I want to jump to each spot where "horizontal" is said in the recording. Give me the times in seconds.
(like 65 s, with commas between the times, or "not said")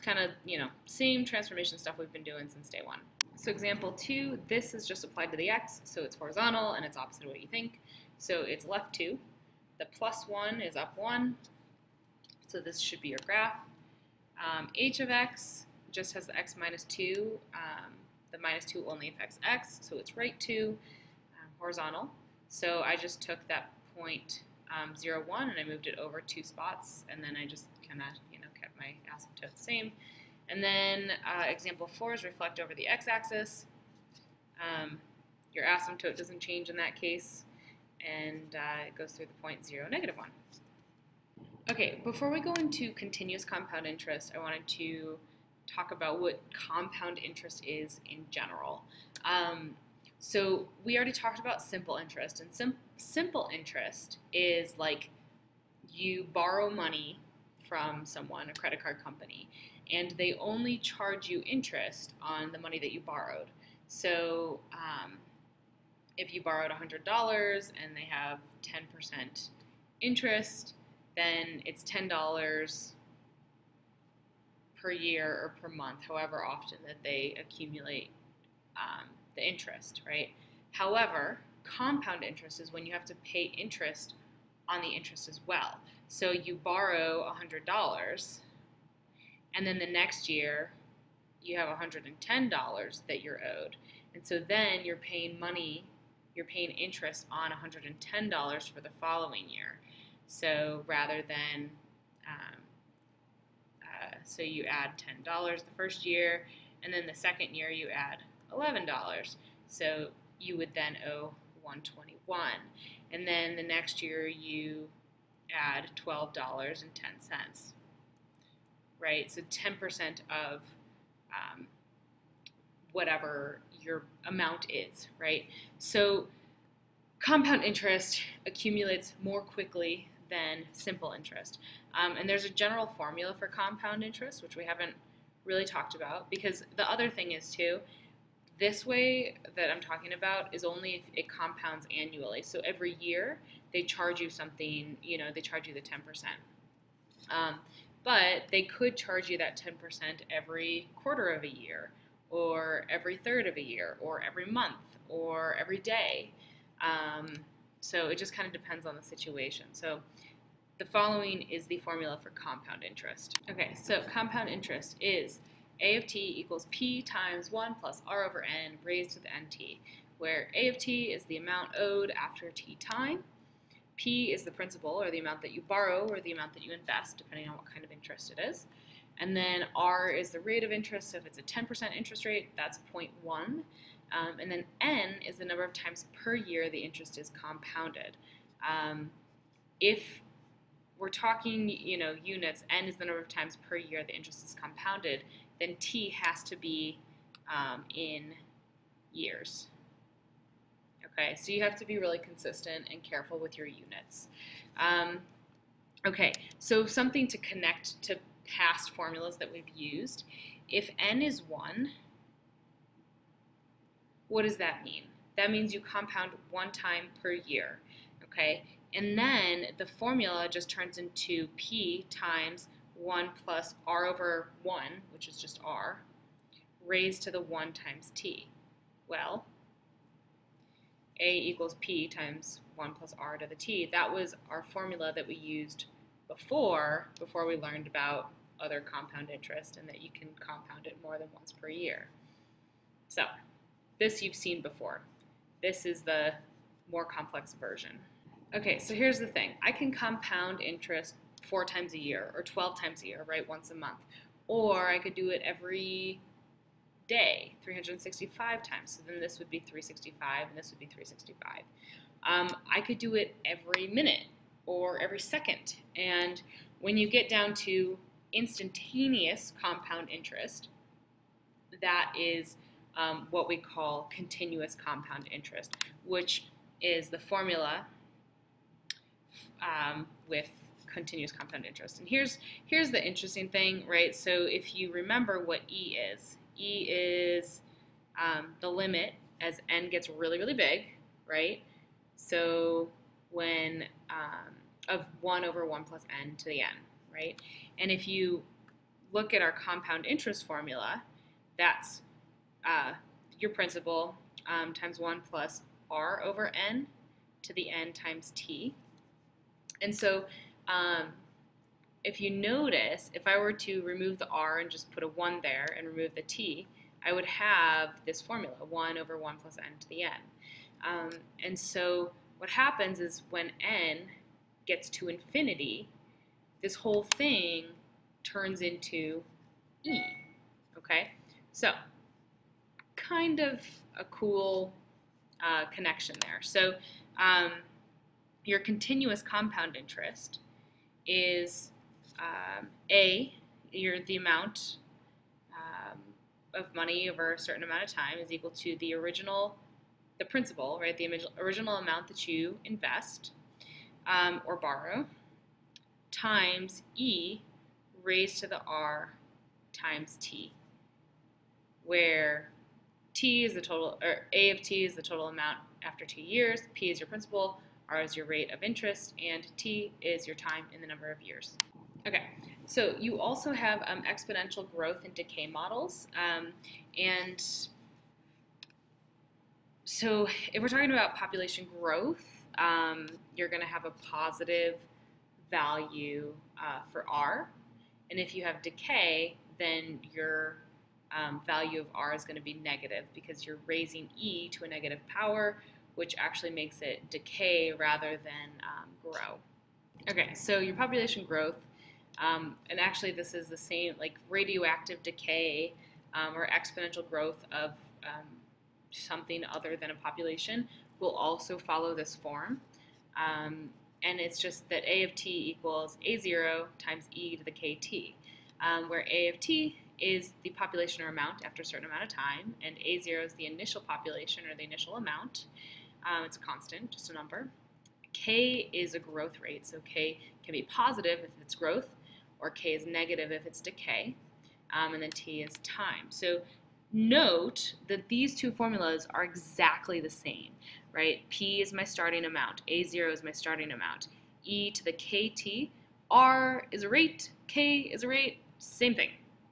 6 s, 21 s.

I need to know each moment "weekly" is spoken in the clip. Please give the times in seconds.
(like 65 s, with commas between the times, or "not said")
not said.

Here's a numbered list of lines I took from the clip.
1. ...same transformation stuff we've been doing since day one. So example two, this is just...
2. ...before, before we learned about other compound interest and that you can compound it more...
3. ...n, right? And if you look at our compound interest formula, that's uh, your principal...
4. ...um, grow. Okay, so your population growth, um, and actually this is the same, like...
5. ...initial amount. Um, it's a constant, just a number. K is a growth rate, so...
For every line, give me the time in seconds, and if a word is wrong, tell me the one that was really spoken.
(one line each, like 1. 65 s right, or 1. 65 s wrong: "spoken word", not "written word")
1. 0 s right
2. 236 s right
3. 296 s right
4. 398 s right
5. 424 s right.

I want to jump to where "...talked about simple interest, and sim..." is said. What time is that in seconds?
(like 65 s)
51 s.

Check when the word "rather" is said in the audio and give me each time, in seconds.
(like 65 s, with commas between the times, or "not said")
100 s, 397 s.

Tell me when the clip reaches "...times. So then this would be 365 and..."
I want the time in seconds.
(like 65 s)
258 s.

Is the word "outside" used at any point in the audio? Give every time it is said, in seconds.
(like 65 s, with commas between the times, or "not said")
not said.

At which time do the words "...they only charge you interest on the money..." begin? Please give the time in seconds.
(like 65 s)
60 s.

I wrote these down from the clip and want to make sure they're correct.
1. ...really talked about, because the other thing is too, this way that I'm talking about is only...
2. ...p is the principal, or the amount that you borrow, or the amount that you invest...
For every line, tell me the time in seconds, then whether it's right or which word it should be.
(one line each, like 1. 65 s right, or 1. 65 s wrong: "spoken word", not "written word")
1. 135 s right
2. 173 s right.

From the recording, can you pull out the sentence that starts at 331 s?
So kind of a cool uh, connection there.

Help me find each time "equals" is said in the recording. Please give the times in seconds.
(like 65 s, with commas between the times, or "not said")
166 s, 231 s, 348 s, 415 s.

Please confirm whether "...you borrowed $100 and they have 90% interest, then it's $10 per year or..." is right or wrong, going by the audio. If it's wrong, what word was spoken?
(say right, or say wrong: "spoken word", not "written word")
wrong: "10", not "90".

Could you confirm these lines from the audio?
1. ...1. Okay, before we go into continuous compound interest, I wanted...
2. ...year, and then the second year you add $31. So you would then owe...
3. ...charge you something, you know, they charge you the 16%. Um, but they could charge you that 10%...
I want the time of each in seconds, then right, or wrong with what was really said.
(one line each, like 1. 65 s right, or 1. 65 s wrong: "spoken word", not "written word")
1. 40 s right
2. 106 s wrong: "11", not "31"
3. 143 s wrong: "10", not "16".